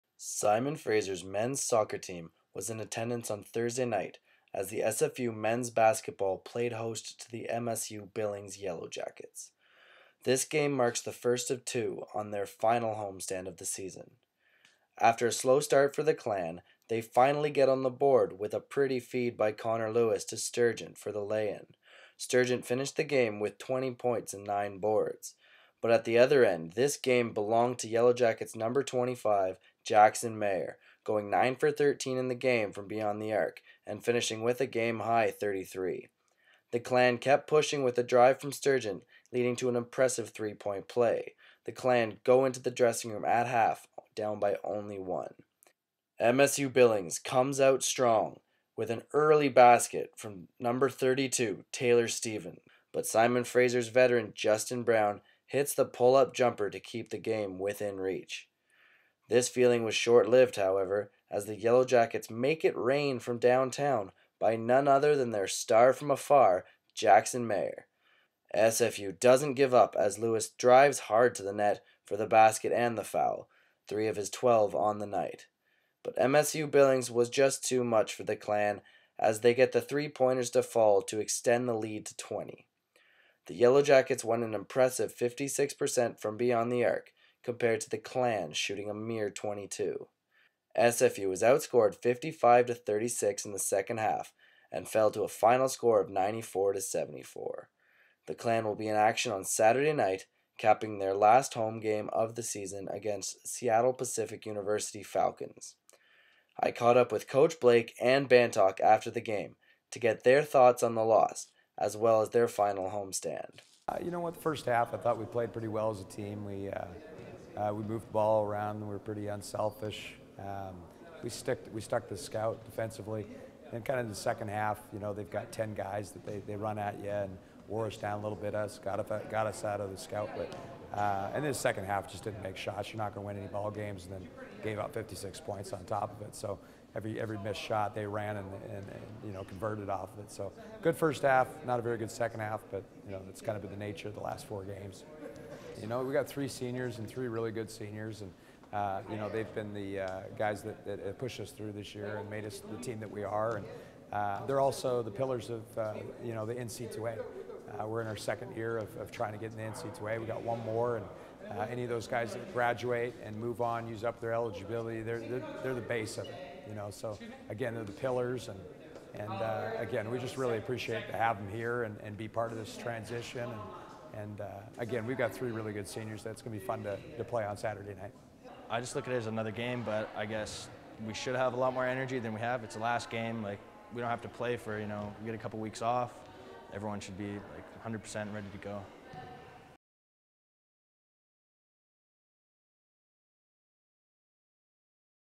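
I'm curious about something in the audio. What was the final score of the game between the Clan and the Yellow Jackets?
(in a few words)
94 to 74.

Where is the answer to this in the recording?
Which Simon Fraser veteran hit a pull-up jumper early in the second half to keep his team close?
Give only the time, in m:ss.
0:54.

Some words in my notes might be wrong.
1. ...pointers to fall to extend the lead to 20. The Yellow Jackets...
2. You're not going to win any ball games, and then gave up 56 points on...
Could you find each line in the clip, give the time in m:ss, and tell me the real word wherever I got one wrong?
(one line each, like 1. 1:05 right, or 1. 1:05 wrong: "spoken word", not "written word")
1. 1:20 right
2. 2:12 right.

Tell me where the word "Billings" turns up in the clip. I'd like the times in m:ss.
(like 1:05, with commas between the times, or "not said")
0:08, 0:46, 1:16.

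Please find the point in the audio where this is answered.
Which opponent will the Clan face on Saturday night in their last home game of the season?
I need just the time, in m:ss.
1:43.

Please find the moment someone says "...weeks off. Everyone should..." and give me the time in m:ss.
3:05.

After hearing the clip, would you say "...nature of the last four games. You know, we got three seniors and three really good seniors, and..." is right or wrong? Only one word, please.
right.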